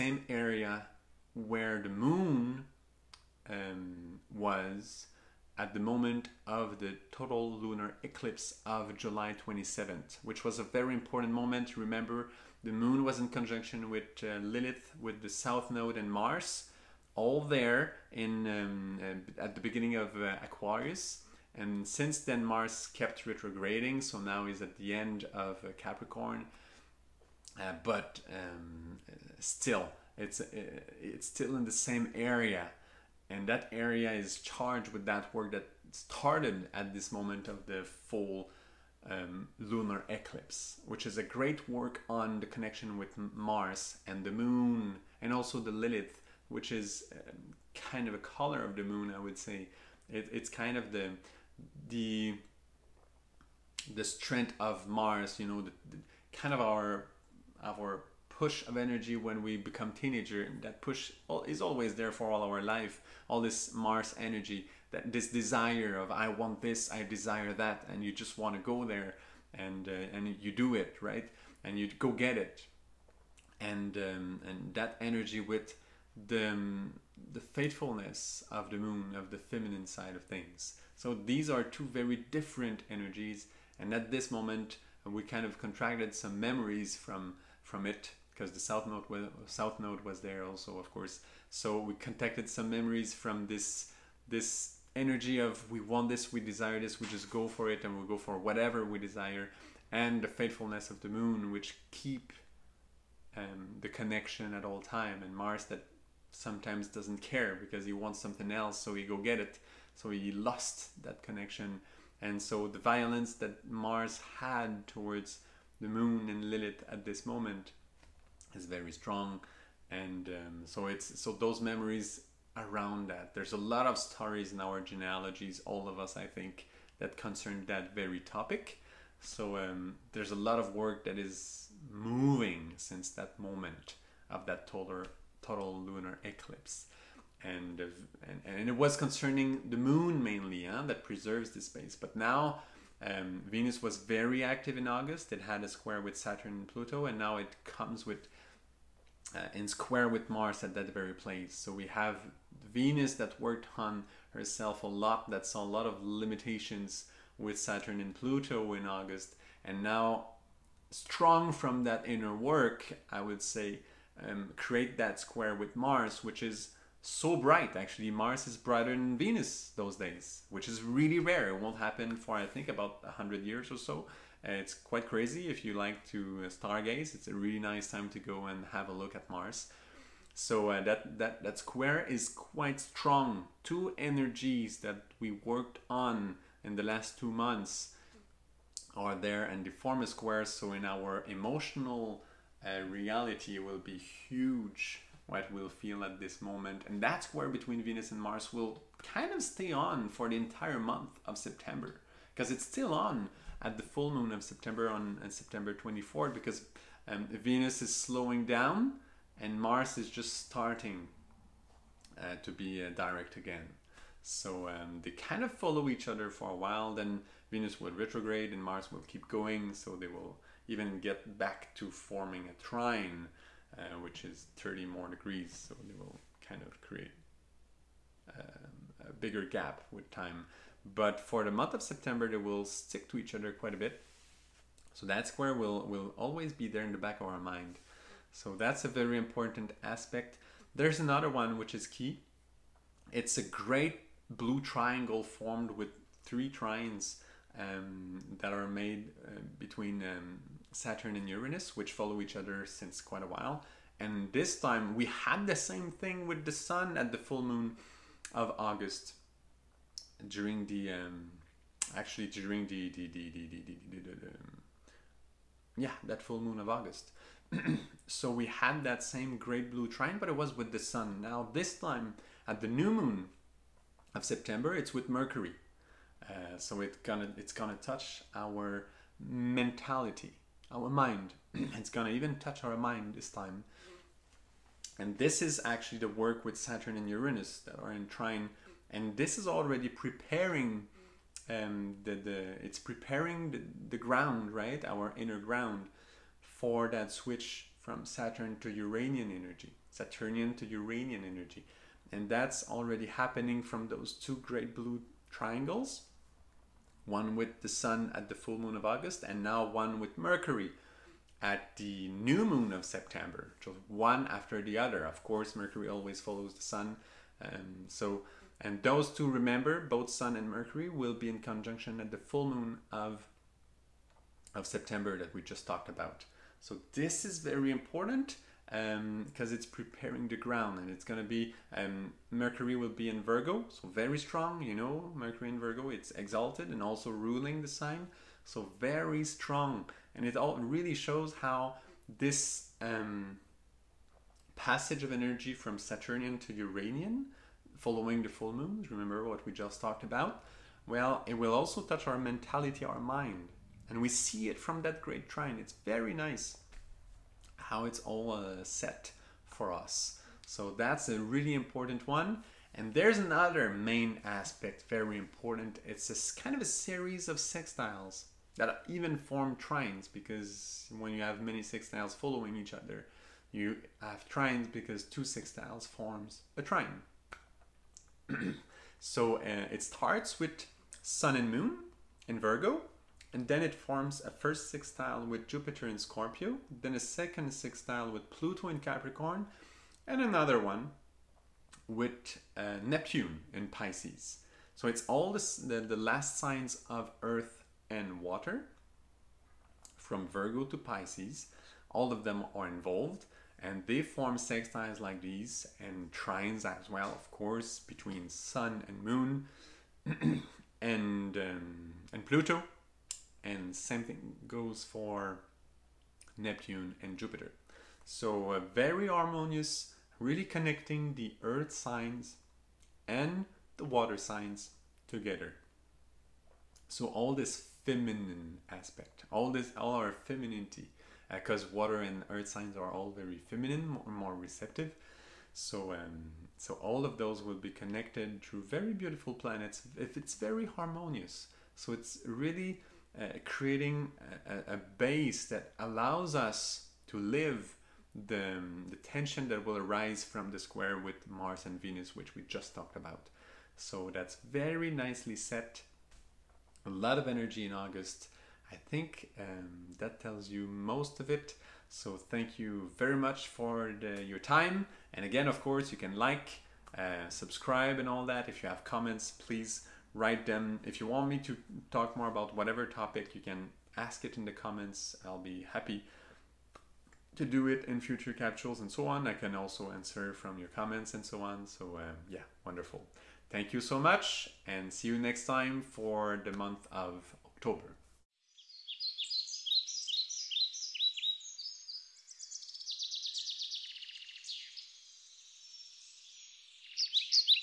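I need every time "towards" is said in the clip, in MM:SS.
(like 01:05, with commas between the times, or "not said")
01:54.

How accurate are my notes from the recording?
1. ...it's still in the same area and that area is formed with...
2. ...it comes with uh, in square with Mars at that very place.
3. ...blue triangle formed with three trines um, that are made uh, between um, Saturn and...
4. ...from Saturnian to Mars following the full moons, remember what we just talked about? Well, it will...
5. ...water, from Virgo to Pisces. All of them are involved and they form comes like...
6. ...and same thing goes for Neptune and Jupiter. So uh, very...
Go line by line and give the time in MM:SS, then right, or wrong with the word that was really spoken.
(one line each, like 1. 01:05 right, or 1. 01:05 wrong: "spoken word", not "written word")
1. 00:31 wrong: "charged", not "formed"
2. 02:27 right
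3. 04:04 right
4. 05:45 wrong: "Uranian", not "Mars"
5. 06:38 wrong: "sextiles", not "comes"
6. 06:53 right.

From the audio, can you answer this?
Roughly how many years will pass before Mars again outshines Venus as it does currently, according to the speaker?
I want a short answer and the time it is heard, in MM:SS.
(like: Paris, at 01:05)
100, at 02:53.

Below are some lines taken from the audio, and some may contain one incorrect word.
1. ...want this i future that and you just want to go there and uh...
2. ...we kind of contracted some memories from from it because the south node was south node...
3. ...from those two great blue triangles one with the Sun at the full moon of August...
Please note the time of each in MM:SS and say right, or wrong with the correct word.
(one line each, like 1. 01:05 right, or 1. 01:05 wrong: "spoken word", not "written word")
1. 01:06 wrong: "desire", not "future"
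2. 01:25 right
3. 05:03 right.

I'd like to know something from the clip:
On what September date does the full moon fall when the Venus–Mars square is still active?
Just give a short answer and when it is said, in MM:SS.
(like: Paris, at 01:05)
September 24, at 03:25.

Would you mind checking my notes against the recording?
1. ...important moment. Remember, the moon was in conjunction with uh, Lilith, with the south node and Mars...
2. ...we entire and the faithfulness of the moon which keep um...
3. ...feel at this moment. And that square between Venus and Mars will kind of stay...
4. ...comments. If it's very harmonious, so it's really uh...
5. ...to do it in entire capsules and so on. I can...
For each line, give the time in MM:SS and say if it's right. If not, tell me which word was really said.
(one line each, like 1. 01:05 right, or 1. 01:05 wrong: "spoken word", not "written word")
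1. 00:10 right
2. 01:38 wrong: "desire", not "entire"
3. 03:15 right
4. 07:19 wrong: "planets", not "comments"
5. 07:57 wrong: "future", not "entire".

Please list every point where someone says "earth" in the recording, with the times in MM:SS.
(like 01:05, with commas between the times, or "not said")
06:37, 07:01, 07:12.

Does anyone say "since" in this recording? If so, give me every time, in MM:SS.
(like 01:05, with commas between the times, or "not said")
00:21, 02:12, 04:12.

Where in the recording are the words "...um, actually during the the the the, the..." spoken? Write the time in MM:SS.
04:20.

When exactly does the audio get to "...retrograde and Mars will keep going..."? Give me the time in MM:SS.
03:37.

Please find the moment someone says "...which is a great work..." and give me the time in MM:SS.
00:40.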